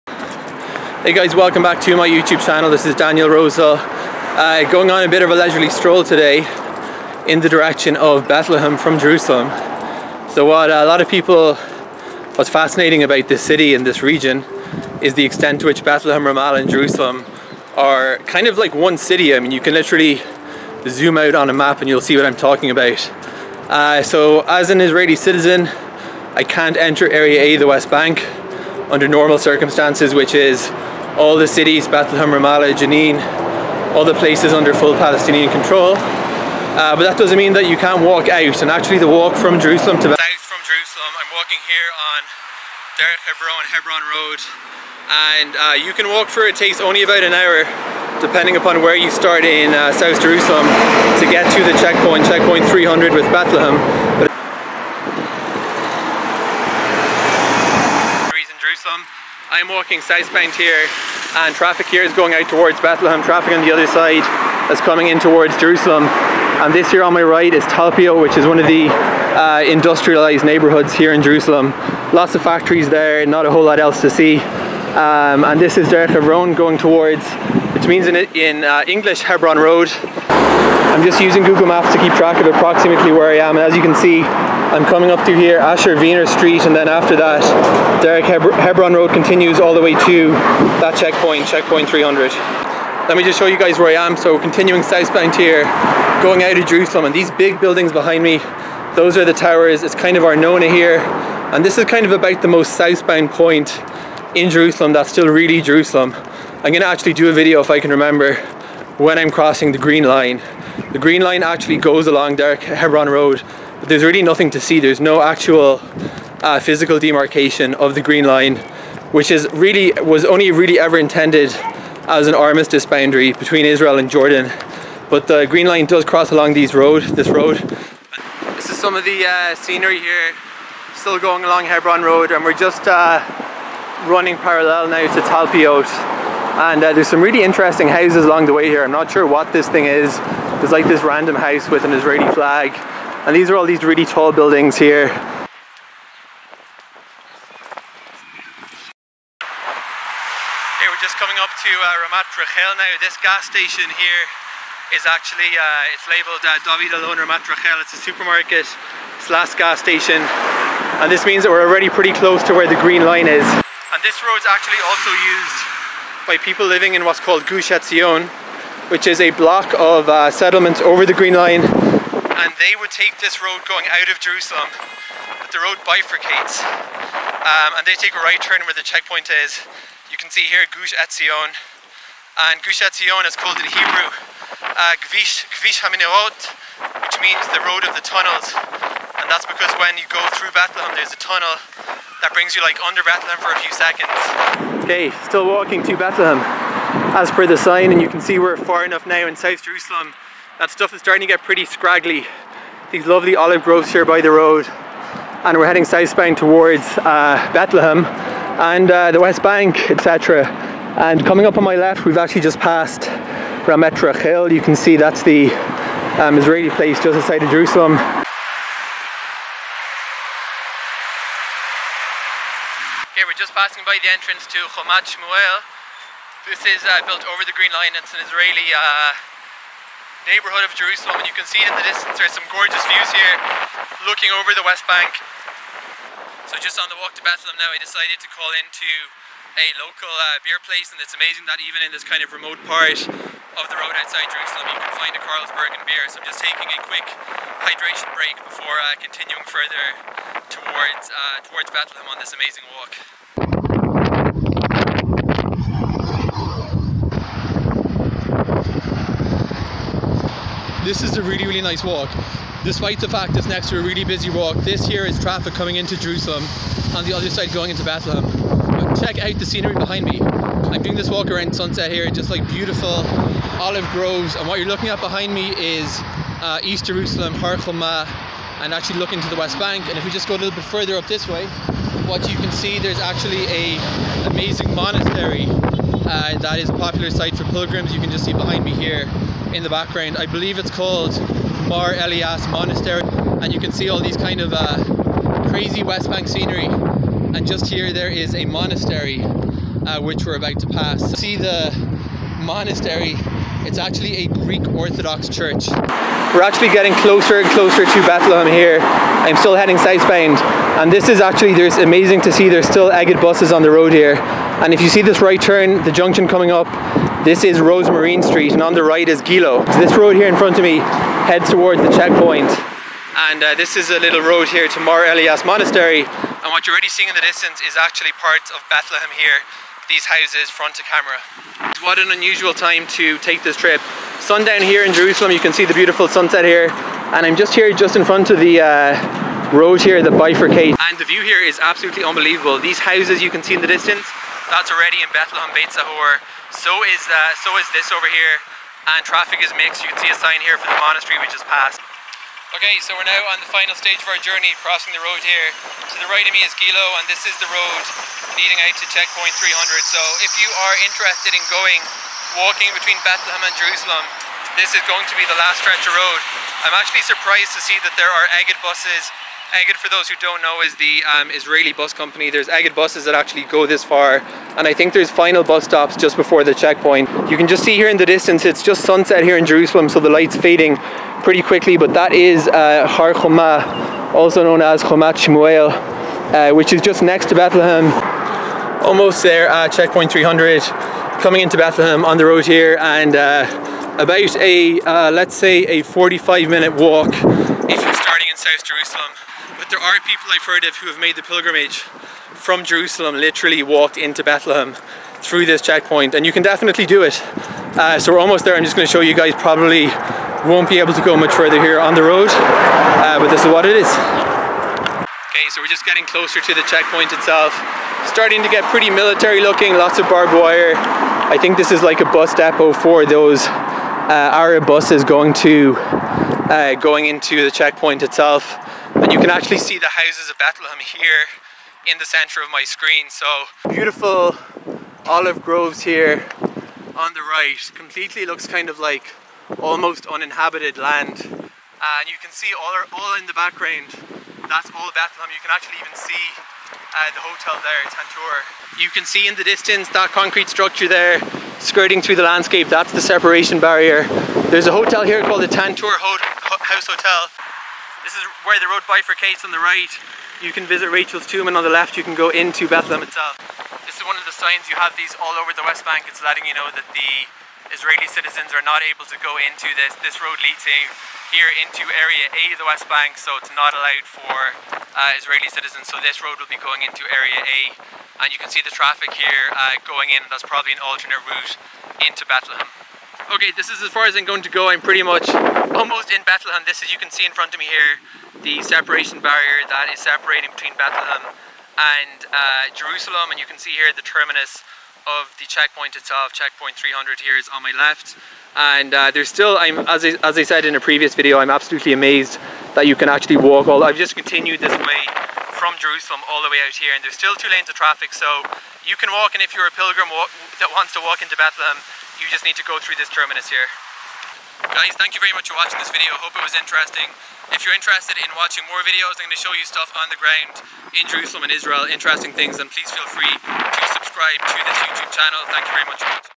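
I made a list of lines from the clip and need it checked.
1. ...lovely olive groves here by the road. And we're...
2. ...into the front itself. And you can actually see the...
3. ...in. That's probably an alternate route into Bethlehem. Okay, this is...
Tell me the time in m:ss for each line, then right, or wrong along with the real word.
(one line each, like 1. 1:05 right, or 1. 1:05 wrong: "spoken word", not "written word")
1. 3:23 right
2. 7:07 wrong: "checkpoint", not "front"
3. 8:00 right.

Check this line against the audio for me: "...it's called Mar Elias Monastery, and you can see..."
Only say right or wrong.
right.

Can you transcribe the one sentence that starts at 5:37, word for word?
And I'm just here just in front of the uh, road here that bifurcates.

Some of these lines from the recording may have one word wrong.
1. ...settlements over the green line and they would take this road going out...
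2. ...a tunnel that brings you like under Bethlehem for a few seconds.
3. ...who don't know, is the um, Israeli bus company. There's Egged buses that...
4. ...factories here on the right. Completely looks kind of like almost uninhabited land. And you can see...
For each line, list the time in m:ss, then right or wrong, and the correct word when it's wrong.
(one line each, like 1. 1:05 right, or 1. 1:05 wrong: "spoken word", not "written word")
1. 2:50 right
2. 3:11 right
3. 6:10 right
4. 7:15 wrong: "groves", not "factories".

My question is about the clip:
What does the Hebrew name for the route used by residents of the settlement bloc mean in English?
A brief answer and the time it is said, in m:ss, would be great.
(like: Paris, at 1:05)
the road of the tunnels, at 3:07.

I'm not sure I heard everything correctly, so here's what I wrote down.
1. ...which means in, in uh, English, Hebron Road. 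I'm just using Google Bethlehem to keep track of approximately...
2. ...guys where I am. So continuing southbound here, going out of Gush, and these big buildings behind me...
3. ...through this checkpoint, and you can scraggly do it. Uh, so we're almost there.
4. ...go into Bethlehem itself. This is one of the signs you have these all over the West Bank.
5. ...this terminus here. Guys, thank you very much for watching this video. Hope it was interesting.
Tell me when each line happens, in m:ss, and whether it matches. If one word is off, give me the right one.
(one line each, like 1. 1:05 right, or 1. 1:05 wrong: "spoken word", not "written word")
1. 1:17 wrong: "Maps", not "Bethlehem"
2. 1:33 wrong: "Jerusalem", not "Gush"
3. 6:45 wrong: "definitely", not "scraggly"
4. 7:42 right
5. 8:33 right.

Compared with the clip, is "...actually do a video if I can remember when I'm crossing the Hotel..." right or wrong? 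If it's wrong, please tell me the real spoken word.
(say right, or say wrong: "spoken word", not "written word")
wrong: "Green", not "Hotel".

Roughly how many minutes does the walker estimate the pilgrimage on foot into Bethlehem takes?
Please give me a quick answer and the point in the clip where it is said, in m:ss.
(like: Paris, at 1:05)
45 minutes, at 6:35.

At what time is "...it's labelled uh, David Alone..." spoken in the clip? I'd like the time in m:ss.
2:35.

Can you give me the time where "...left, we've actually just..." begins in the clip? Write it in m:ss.
3:31.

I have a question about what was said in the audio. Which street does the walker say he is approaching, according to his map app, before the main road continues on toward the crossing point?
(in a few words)
Asher Wiener Street.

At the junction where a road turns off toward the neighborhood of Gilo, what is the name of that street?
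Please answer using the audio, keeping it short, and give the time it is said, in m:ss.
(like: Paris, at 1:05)
Rosmarin Street, at 5:17.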